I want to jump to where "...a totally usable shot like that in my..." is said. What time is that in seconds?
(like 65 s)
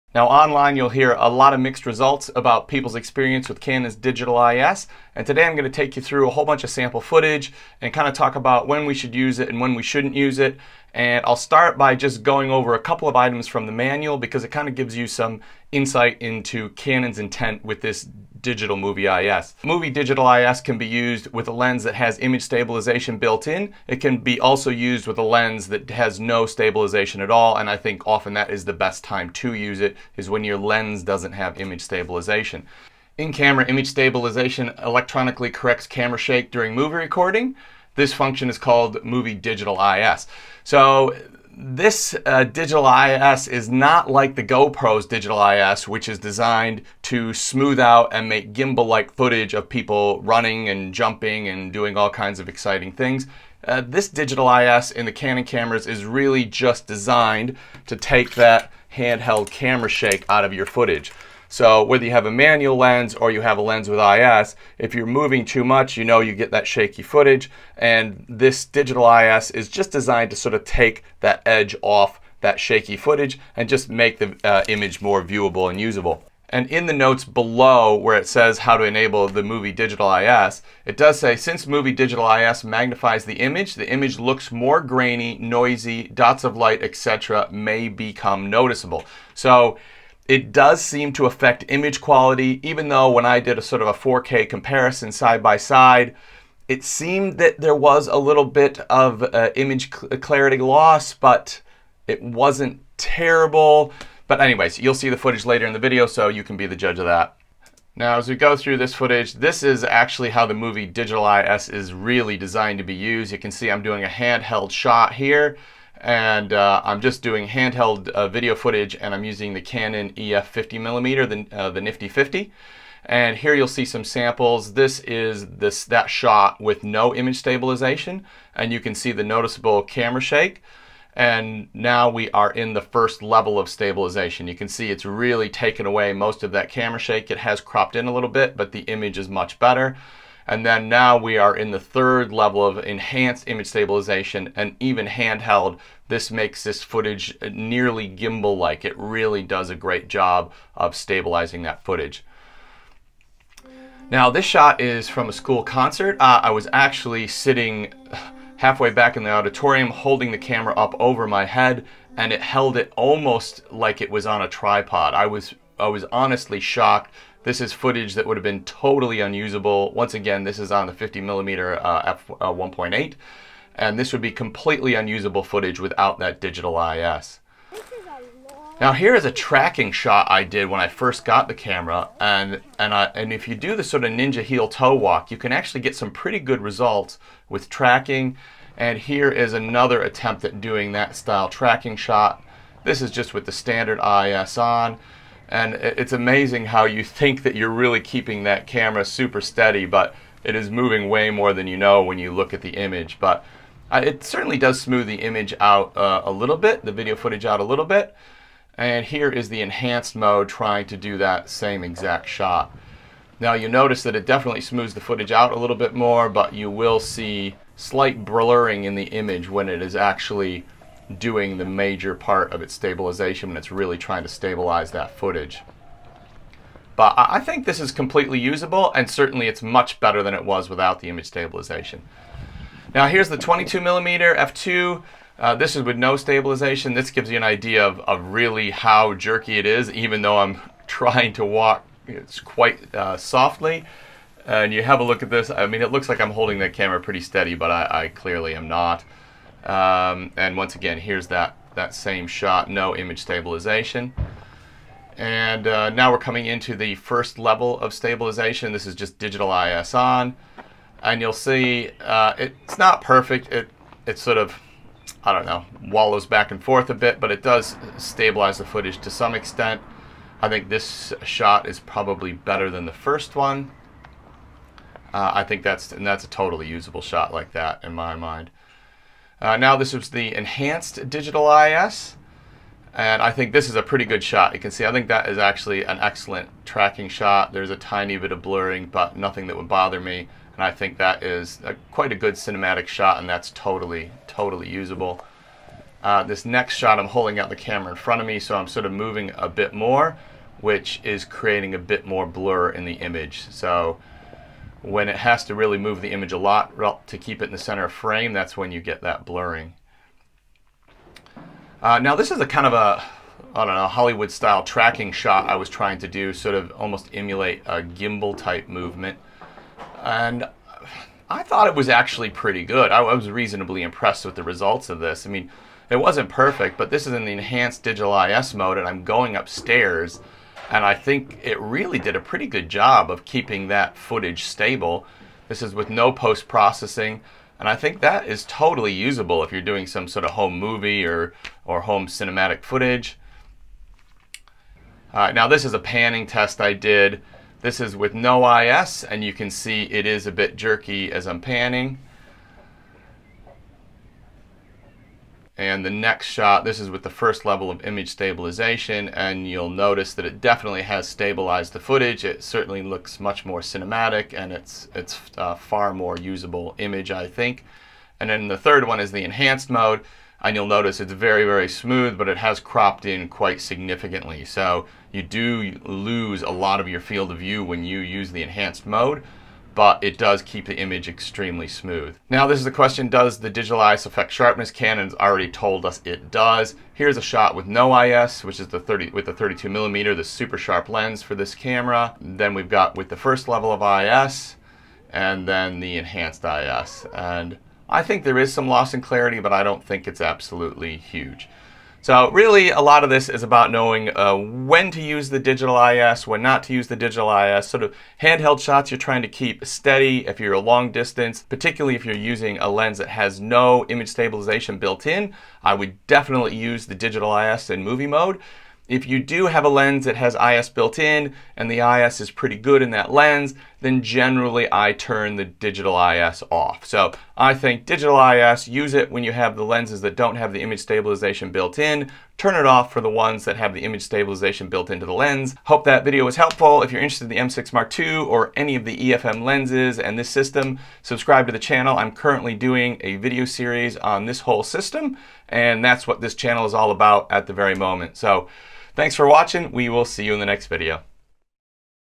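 276 s.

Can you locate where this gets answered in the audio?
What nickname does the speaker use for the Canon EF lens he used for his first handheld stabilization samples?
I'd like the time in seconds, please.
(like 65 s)
121 s.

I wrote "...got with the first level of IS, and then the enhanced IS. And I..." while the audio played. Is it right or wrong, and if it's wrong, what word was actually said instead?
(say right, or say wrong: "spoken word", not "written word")
right.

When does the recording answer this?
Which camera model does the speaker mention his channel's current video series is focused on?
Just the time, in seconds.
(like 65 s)
437 s.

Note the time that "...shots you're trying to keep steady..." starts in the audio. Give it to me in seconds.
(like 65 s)
408 s.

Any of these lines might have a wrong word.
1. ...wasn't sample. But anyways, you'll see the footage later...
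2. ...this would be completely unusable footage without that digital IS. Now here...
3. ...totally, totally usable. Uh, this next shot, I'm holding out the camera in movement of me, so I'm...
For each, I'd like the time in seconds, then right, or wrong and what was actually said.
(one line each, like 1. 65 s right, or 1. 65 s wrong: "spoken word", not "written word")
1. 102 s wrong: "terrible", not "sample"
2. 173 s right
3. 293 s wrong: "front", not "movement".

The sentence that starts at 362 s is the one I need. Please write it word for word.
It certainly looks much more cinematic, and it's, it's a uh, far more usable image, I think.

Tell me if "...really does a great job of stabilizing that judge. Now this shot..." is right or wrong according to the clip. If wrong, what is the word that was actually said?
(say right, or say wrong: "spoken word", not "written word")
wrong: "footage", not "judge".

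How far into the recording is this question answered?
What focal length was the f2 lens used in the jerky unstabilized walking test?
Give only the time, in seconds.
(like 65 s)
233 s.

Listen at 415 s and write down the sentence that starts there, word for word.
I would definitely use the digital IS in movie mode.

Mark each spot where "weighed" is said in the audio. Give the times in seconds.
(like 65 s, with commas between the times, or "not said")
not said.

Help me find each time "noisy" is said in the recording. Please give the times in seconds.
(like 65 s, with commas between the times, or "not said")
85 s.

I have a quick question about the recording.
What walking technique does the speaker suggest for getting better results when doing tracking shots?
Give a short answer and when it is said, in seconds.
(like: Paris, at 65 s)
Ninja heel toe walk, at 184 s.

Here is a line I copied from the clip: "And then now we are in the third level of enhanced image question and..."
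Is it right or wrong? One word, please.
wrong.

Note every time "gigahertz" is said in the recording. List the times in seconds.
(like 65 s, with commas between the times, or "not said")
not said.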